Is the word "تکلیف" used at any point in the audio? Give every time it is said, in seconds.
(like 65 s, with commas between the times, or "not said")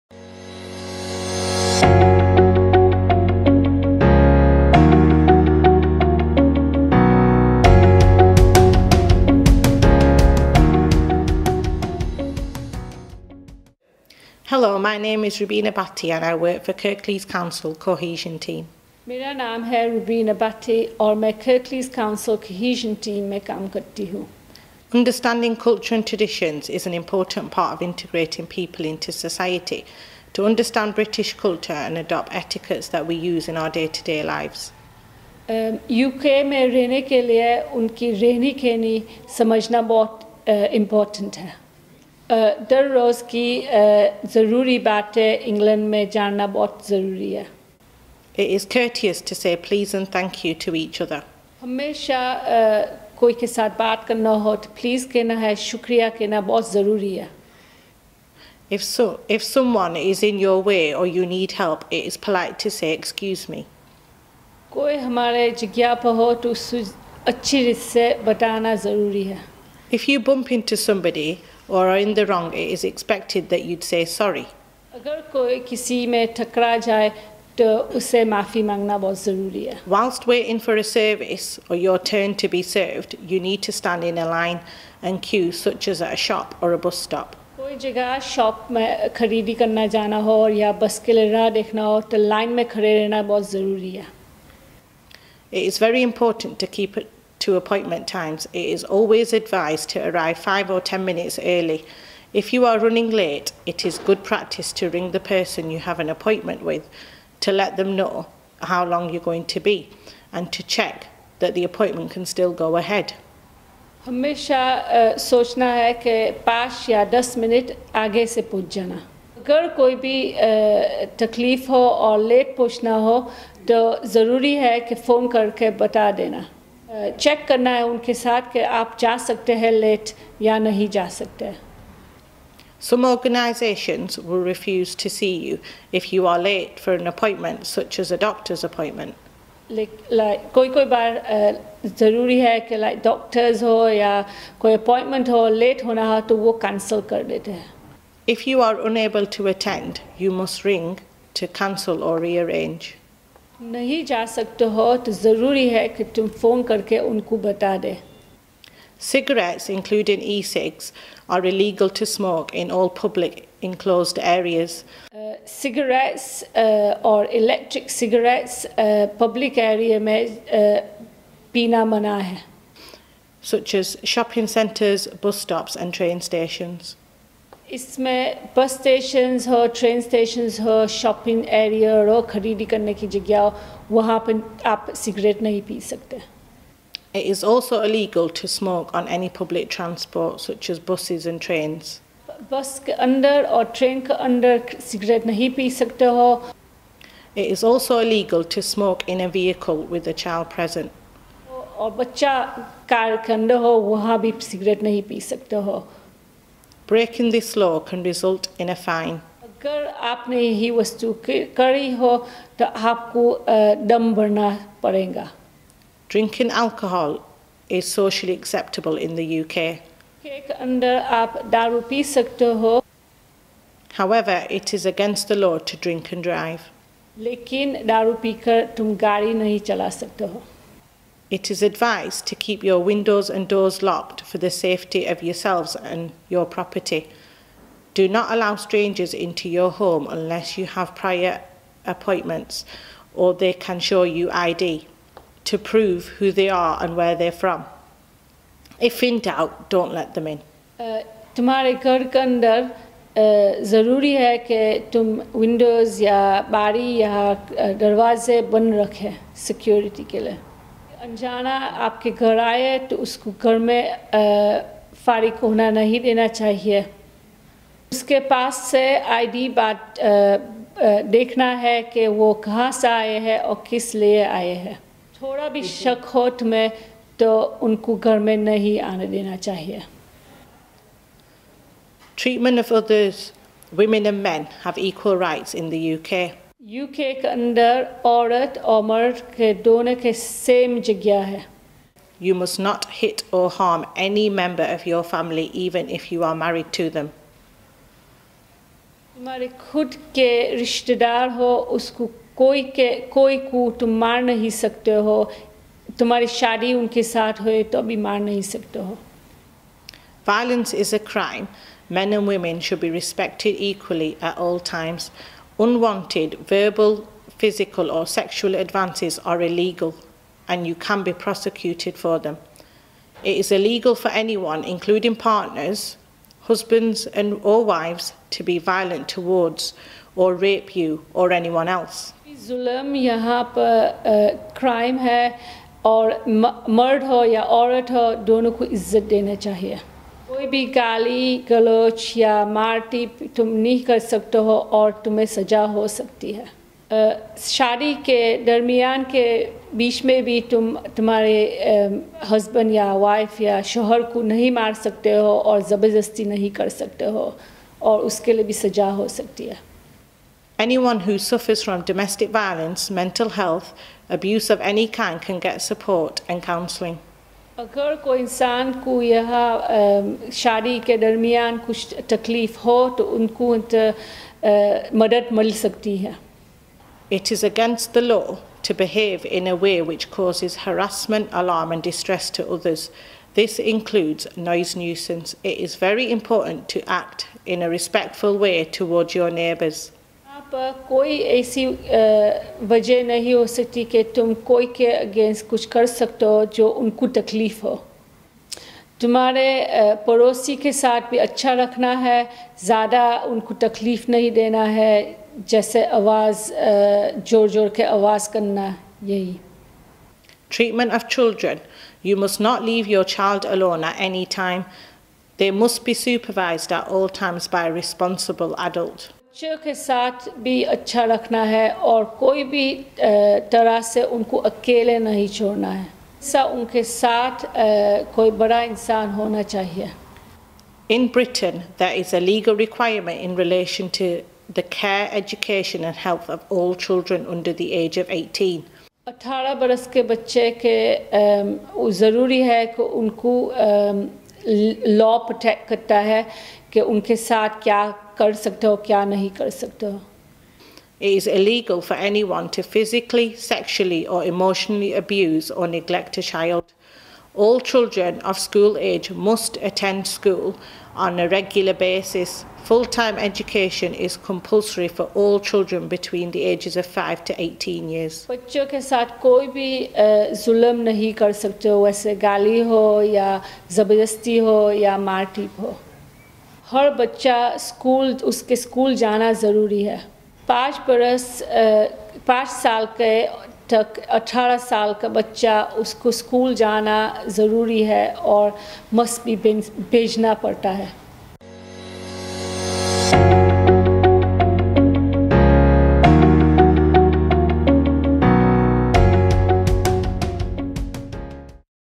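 397 s, 403 s.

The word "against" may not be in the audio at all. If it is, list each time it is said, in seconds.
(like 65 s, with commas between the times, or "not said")
224 s, 377 s.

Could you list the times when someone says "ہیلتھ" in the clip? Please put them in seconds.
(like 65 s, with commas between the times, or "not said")
363 s, 436 s.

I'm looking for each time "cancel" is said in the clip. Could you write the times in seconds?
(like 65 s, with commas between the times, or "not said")
146 s, 151 s.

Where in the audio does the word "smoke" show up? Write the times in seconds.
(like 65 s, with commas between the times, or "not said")
162 s, 188 s, 198 s.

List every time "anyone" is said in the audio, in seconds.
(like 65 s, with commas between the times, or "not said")
324 s, 331 s, 452 s.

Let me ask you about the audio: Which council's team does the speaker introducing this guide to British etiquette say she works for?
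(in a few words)
Kirklees Council.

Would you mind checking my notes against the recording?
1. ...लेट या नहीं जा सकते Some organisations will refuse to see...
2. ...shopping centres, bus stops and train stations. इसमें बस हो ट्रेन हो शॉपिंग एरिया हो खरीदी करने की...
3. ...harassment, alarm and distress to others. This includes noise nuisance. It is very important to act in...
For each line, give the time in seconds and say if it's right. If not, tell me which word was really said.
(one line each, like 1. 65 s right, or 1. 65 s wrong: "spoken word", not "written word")
1. 129 s right
2. 174 s right
3. 380 s right.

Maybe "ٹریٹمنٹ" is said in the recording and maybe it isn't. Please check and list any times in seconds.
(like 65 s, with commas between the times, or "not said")
410 s.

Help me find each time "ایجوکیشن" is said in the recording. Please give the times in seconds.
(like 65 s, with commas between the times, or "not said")
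435 s.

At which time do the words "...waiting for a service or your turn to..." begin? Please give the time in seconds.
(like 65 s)
80 s.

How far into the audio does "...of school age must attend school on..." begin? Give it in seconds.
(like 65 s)
458 s.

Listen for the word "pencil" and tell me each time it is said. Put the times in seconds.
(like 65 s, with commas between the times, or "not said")
not said.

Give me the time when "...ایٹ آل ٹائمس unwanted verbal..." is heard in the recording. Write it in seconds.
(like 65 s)
314 s.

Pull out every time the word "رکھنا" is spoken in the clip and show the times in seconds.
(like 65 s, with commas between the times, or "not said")
401 s, 421 s.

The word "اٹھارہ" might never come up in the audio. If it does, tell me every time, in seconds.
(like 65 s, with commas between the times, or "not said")
439 s, 484 s.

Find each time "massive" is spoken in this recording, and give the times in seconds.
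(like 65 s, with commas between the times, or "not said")
not said.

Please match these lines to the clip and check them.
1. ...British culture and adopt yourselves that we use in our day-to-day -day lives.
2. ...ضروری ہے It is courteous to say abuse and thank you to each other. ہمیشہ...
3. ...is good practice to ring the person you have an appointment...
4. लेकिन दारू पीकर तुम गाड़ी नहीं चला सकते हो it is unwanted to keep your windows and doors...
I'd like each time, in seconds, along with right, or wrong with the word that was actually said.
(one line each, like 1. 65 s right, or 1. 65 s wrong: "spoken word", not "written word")
1. 31 s wrong: "etiquettes", not "yourselves"
2. 46 s wrong: "please", not "abuse"
3. 103 s right
4. 227 s wrong: "advised", not "unwanted".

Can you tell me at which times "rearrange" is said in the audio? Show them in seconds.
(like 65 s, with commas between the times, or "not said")
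152 s.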